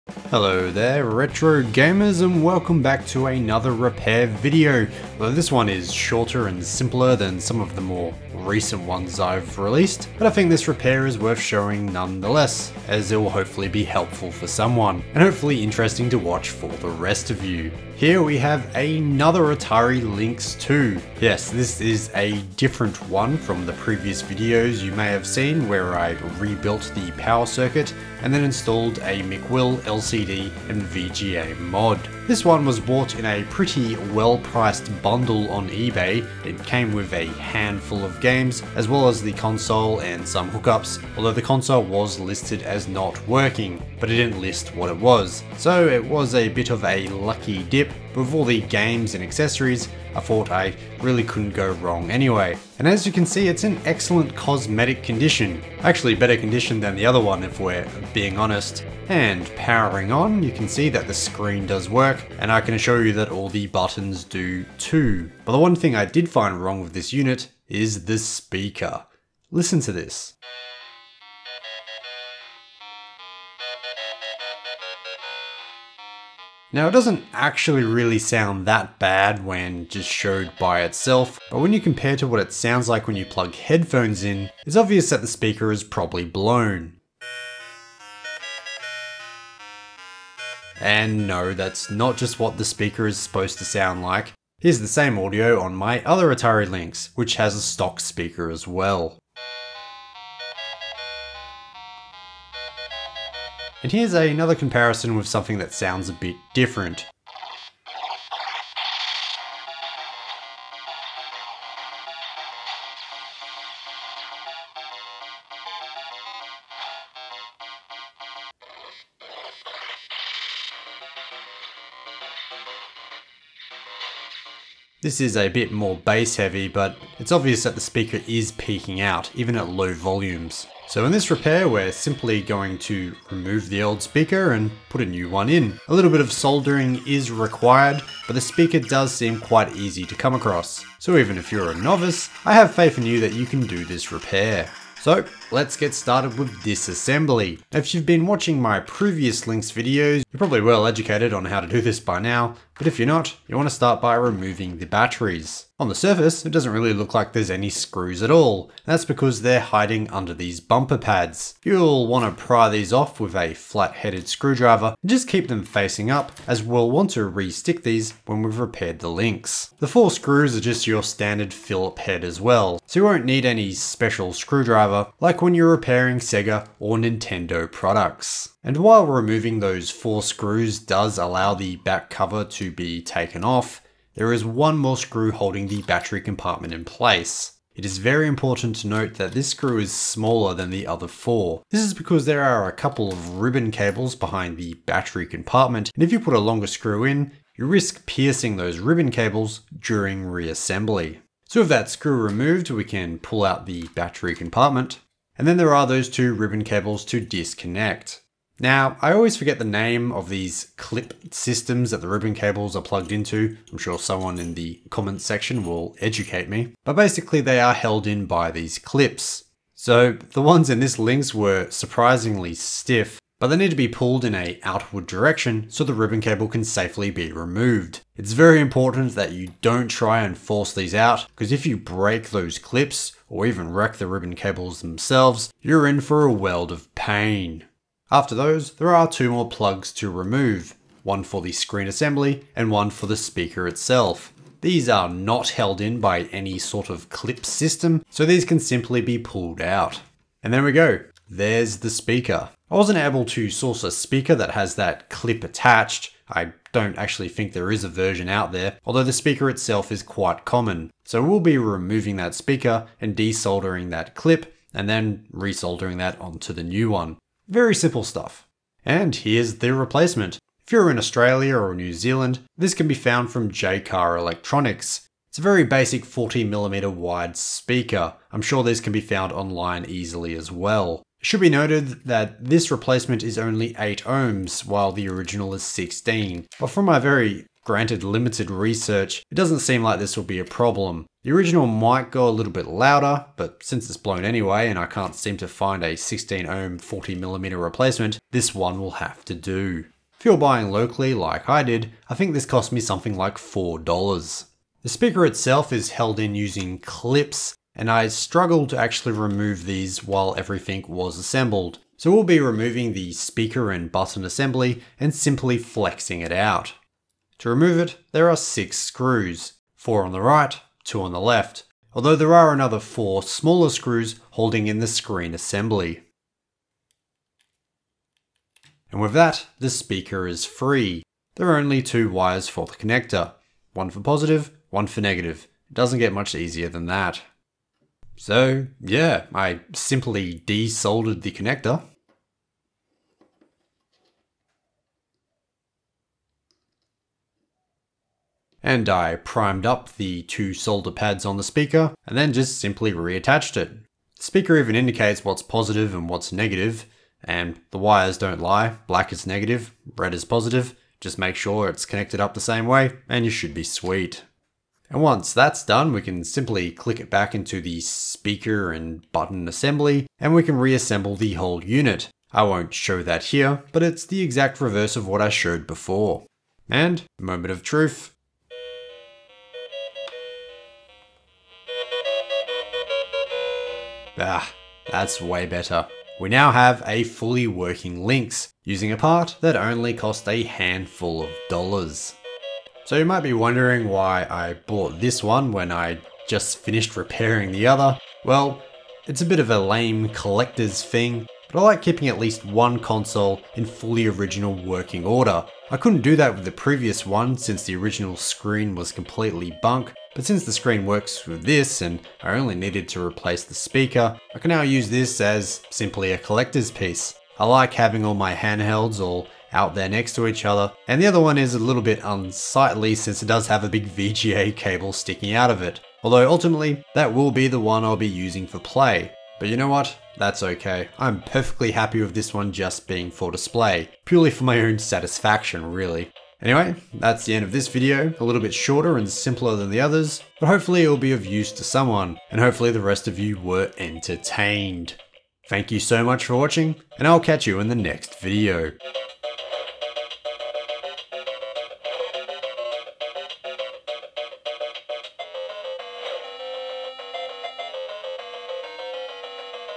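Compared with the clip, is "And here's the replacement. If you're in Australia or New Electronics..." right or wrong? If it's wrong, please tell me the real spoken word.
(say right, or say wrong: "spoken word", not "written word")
wrong: "Zealand", not "Electronics".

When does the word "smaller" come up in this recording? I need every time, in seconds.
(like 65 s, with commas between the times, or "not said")
189 s, 323 s.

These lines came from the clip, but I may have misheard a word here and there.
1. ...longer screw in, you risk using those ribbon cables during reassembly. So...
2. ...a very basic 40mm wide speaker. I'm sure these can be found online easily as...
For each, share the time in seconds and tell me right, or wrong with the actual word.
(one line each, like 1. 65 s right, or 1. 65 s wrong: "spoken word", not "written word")
1. 196 s wrong: "piercing", not "using"
2. 275 s right.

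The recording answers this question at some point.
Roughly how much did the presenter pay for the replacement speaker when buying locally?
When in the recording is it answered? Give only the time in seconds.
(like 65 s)
303 s.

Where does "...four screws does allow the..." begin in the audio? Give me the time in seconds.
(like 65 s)
179 s.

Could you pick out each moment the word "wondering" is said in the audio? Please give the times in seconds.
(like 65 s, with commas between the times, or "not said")
393 s.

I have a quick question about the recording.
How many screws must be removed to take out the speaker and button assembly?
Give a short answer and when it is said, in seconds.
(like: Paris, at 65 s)
6, at 318 s.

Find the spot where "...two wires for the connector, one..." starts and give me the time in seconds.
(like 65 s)
331 s.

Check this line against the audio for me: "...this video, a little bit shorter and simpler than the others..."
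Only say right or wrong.
right.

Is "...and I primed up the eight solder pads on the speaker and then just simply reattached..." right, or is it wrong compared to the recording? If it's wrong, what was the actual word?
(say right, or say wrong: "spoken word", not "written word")
wrong: "two", not "eight".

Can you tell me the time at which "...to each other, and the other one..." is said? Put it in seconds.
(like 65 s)
420 s.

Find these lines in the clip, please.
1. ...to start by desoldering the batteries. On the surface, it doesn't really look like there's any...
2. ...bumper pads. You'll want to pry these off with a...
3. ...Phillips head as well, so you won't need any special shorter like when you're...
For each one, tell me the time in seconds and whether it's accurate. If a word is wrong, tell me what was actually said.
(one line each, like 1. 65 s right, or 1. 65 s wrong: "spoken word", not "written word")
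1. 153 s wrong: "removing", not "desoldering"
2. 160 s right
3. 171 s wrong: "screwdriver", not "shorter".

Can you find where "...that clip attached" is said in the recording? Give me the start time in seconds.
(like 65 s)
254 s.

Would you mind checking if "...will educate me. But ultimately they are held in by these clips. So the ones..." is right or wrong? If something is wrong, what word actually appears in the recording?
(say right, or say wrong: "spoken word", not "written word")
wrong: "basically", not "ultimately".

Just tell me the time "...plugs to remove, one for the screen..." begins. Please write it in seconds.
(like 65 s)
239 s.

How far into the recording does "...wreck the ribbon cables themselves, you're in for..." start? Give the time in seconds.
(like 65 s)
233 s.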